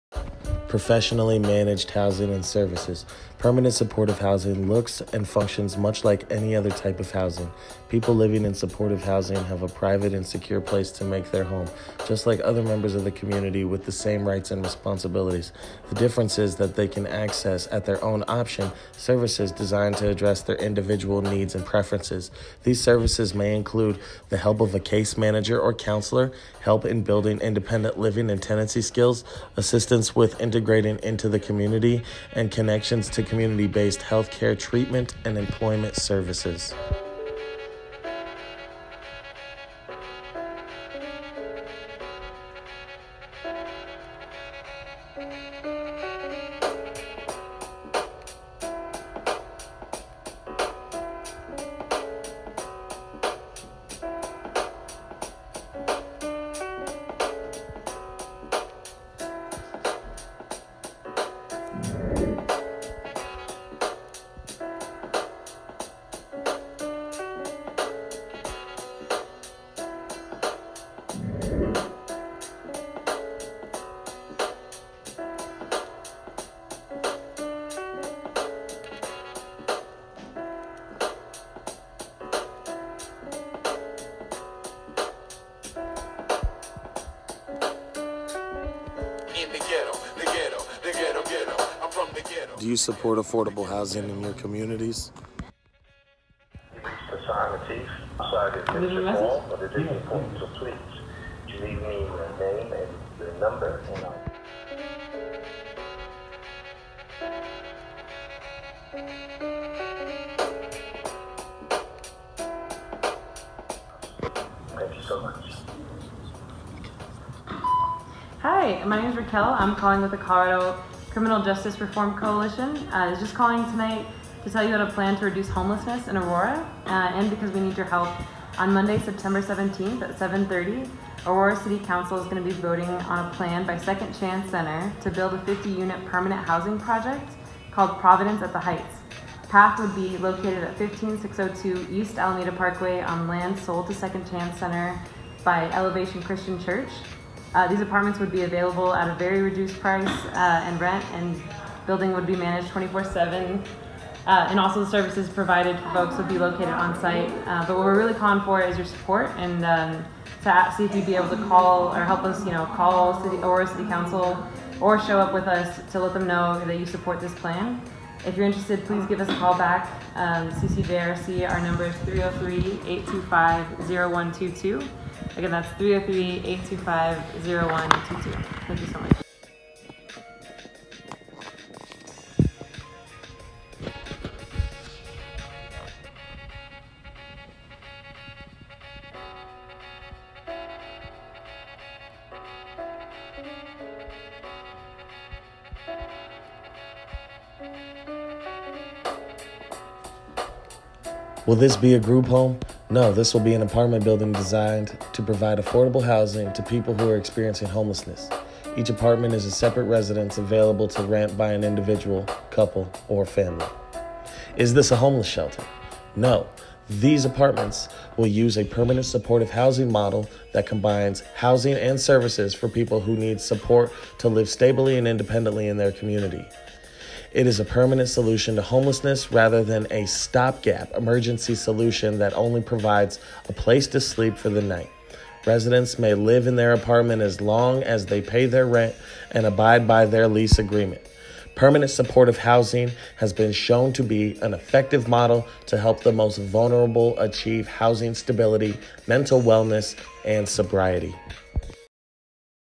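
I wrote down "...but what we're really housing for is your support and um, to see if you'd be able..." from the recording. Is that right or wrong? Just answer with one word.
wrong.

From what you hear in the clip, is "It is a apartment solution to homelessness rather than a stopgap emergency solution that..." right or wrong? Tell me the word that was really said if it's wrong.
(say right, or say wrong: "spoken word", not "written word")
wrong: "permanent", not "apartment".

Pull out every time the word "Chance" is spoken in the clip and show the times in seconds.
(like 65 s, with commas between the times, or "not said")
134 s, 144 s.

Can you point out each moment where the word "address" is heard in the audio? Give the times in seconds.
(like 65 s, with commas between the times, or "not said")
20 s.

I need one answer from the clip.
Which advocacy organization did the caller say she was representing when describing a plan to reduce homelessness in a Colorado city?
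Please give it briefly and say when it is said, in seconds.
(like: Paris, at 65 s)
Colorado Criminal Justice Reform Coalition, at 120 s.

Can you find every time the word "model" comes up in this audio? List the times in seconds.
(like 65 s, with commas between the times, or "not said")
219 s, 245 s.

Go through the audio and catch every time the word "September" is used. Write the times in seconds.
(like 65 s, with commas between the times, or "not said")
128 s.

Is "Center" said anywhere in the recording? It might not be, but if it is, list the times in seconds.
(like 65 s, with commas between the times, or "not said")
134 s, 144 s.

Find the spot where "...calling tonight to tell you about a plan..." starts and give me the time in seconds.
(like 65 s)
123 s.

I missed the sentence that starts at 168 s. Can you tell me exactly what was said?
If you're interested, please give us a call back.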